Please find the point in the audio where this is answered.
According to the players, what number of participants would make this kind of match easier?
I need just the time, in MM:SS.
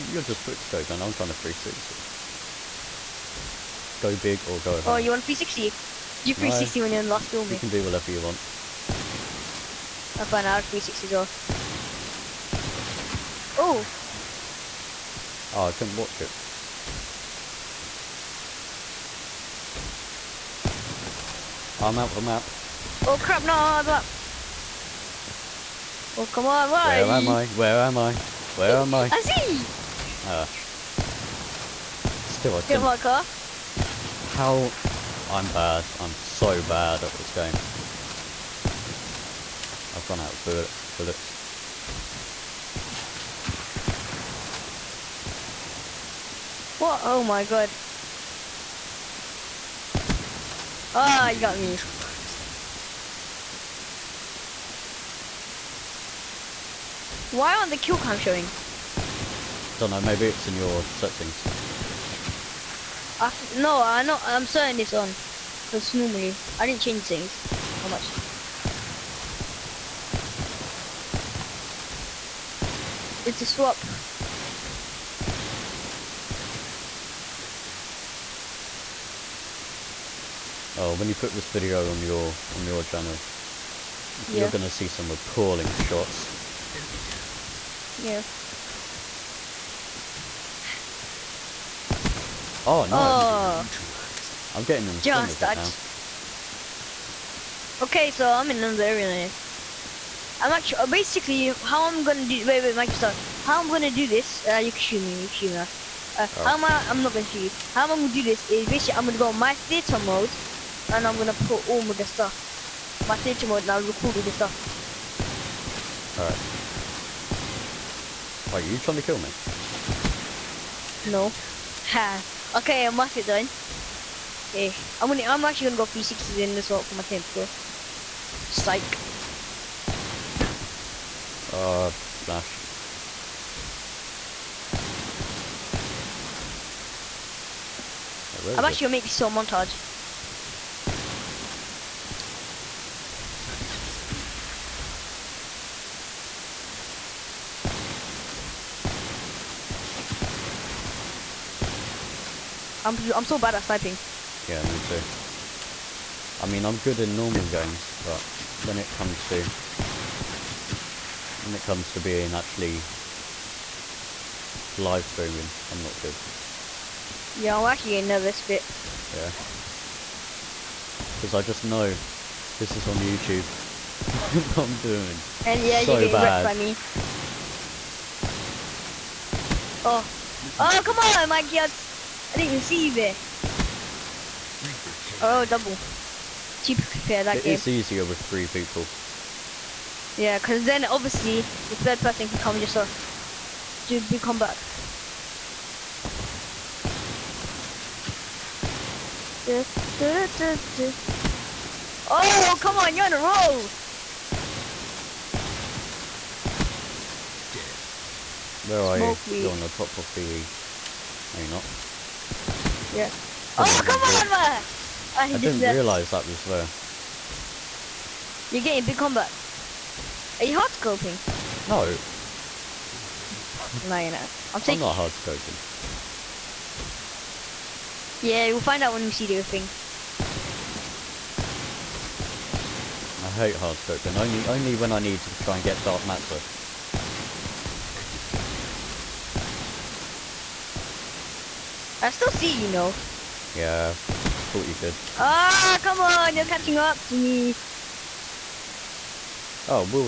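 03:08.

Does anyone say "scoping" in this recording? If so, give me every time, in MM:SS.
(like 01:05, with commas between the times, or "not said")
03:40, 03:45, 03:53.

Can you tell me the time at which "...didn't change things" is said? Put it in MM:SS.
01:06.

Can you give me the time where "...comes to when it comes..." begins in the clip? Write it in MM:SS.
02:38.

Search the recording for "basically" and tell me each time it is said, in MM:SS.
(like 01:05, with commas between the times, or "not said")
01:40, 01:48.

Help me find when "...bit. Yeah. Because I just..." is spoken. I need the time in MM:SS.
02:48.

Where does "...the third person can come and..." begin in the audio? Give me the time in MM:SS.
03:11.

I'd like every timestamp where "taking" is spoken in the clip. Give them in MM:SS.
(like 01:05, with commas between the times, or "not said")
03:44.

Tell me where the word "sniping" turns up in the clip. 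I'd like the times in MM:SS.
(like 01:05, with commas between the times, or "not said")
02:33.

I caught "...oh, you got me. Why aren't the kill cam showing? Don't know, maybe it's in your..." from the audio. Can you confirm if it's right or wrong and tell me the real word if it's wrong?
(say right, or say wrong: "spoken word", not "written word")
right.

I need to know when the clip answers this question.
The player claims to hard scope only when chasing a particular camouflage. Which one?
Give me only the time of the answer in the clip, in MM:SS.
03:55.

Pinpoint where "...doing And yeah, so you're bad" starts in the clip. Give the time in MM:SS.
02:54.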